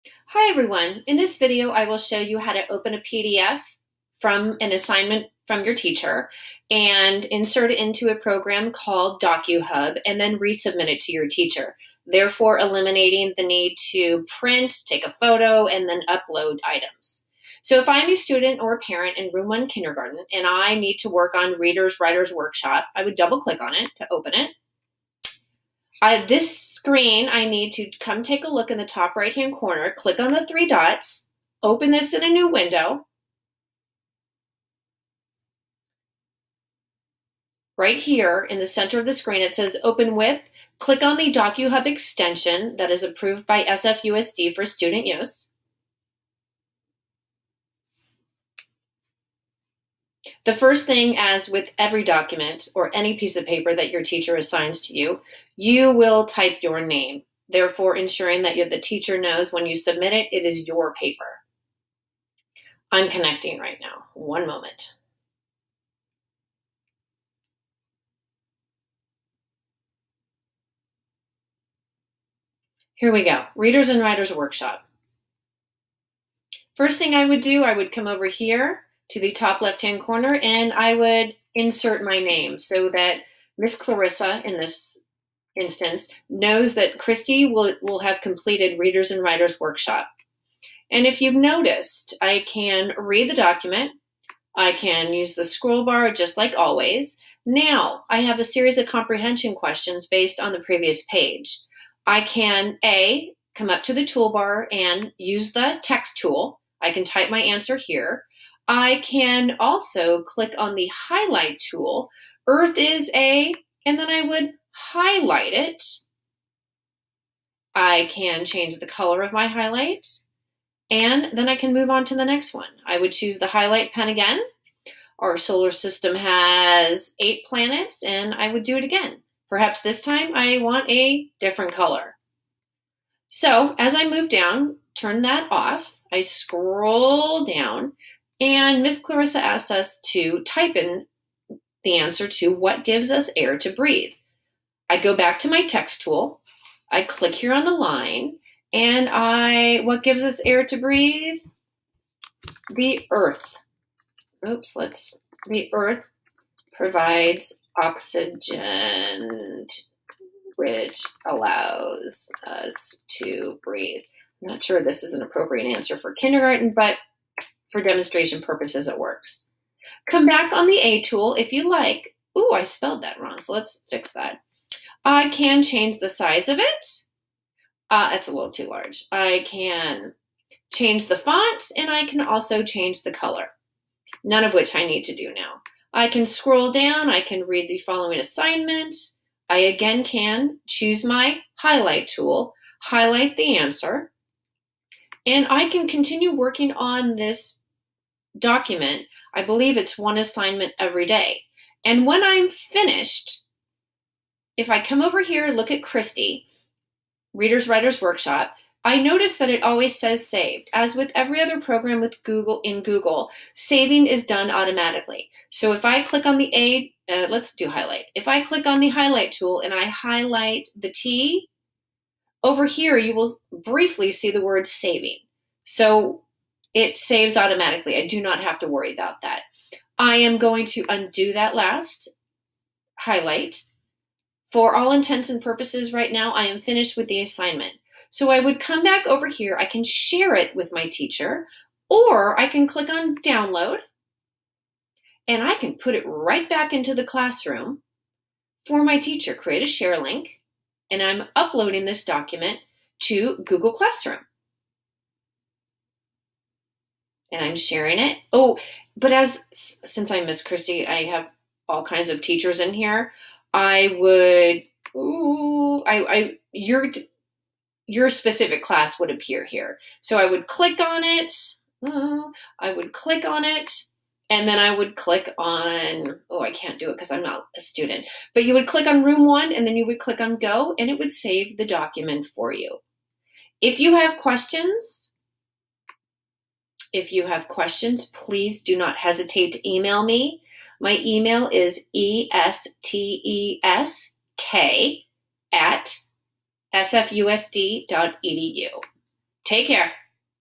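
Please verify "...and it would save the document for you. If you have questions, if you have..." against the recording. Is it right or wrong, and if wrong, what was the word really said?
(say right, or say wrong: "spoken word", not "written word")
right.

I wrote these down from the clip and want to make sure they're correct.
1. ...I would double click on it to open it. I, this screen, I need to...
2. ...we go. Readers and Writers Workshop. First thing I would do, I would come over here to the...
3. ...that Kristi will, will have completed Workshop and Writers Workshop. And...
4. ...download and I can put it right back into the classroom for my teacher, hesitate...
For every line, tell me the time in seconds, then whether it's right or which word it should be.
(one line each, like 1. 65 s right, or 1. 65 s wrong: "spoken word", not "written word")
1. 22 s right
2. 73 s right
3. 86 s wrong: "Readers", not "Workshop"
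4. 243 s wrong: "create", not "hesitate".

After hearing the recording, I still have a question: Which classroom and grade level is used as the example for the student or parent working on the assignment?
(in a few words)
Room one kindergarten.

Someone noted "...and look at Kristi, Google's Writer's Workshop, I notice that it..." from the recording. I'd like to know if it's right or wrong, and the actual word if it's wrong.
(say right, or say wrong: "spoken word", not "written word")
wrong: "Reader", not "Google".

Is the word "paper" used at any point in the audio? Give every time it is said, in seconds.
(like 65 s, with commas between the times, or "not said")
53 s, 60 s.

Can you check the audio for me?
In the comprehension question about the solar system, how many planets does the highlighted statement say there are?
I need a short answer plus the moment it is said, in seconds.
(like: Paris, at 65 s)
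8, at 127 s.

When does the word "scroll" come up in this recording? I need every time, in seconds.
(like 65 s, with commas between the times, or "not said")
95 s, 136 s, 186 s.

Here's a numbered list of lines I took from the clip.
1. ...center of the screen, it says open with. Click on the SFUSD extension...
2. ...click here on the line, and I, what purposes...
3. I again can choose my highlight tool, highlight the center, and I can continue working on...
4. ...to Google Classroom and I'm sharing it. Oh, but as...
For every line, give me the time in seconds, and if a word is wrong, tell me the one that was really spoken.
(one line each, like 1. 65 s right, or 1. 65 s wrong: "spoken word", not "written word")
1. 38 s wrong: "DocHub", not "SFUSD"
2. 147 s wrong: "gives", not "purposes"
3. 189 s wrong: "answer", not "center"
4. 253 s right.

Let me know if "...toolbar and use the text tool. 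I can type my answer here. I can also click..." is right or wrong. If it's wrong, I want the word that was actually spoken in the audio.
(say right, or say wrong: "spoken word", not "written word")
right.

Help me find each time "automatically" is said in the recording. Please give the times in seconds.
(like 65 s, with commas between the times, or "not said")
214 s, 227 s.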